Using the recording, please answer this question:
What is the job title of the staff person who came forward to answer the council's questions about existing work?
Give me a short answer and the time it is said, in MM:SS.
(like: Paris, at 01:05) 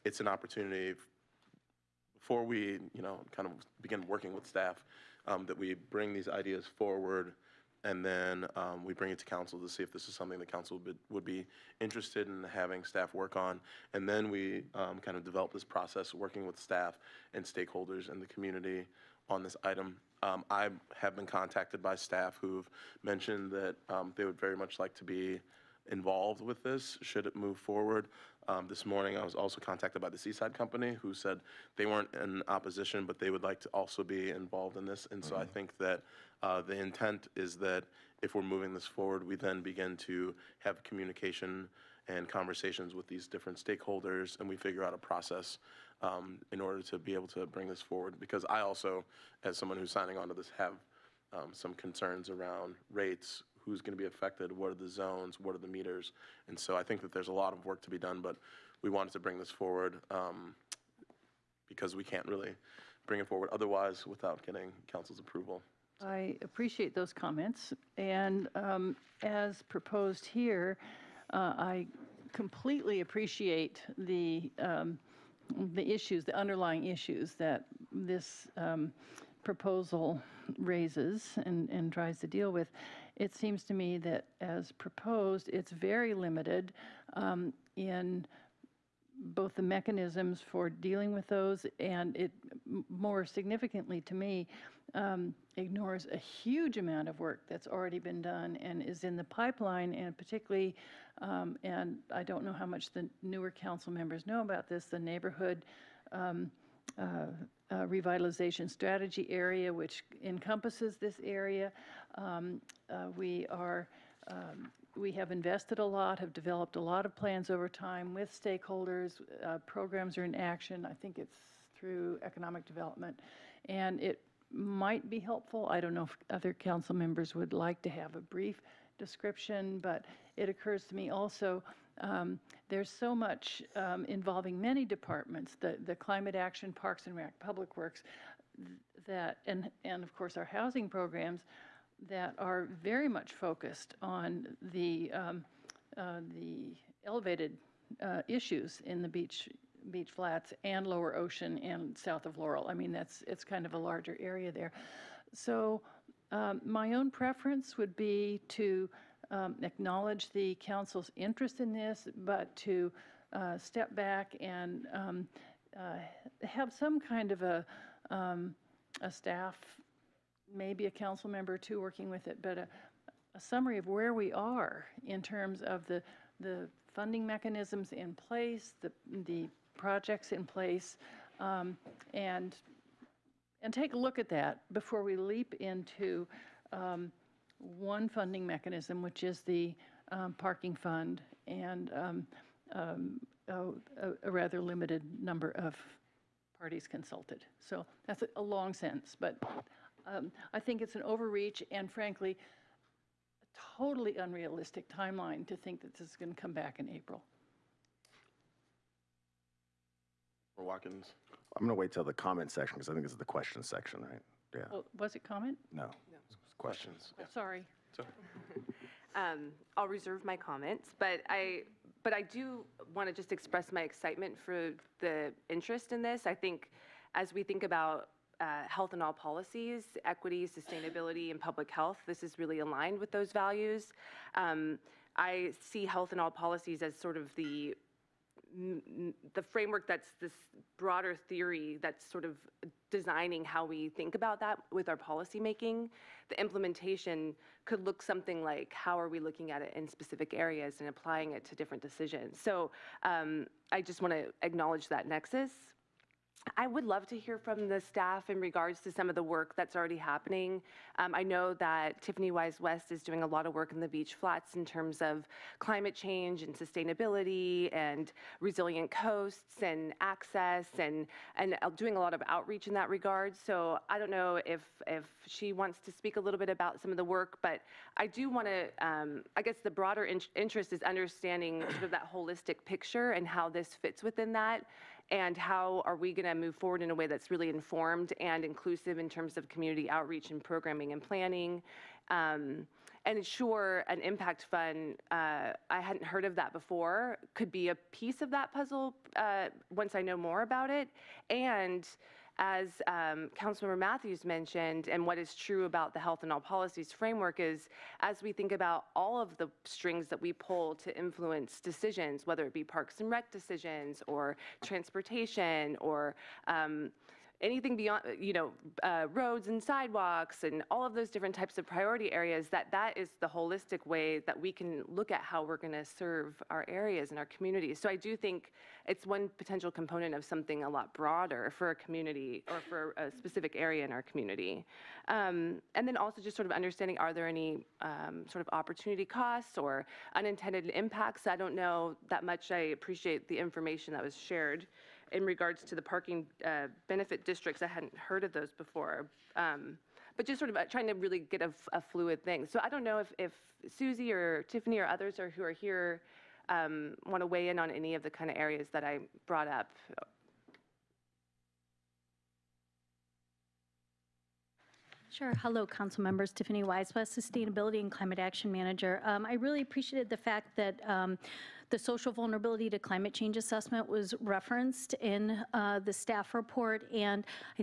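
Sustainability and Climate Action Manager, at 06:07.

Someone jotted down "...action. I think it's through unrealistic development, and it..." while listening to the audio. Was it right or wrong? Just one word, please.
wrong.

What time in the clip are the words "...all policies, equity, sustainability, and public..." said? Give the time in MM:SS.
03:49.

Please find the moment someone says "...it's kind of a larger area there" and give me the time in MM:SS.
02:33.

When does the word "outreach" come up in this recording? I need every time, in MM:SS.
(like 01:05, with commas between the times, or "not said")
04:32, 04:49.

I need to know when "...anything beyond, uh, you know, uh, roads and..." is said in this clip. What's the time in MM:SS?
05:17.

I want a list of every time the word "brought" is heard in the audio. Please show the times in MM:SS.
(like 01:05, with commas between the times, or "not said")
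05:59.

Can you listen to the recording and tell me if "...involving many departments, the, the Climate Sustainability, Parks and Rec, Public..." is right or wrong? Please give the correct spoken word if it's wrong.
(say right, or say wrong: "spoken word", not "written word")
wrong: "Action", not "Sustainability".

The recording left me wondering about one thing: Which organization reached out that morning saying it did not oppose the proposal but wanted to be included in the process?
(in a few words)
Seaside Company.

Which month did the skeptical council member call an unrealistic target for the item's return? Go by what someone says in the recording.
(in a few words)
April.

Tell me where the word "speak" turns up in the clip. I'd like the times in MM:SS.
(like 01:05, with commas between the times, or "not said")
04:35.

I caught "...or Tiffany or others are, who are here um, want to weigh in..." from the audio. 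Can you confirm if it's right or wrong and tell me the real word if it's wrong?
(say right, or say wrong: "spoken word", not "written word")
right.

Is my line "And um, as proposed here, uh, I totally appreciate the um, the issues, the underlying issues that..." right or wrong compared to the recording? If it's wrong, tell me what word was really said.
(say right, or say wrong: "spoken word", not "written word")
wrong: "completely", not "totally".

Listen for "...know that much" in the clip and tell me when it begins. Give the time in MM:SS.
05:41.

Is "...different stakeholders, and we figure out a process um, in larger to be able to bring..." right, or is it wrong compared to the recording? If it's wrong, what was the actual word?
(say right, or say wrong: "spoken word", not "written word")
wrong: "order", not "larger".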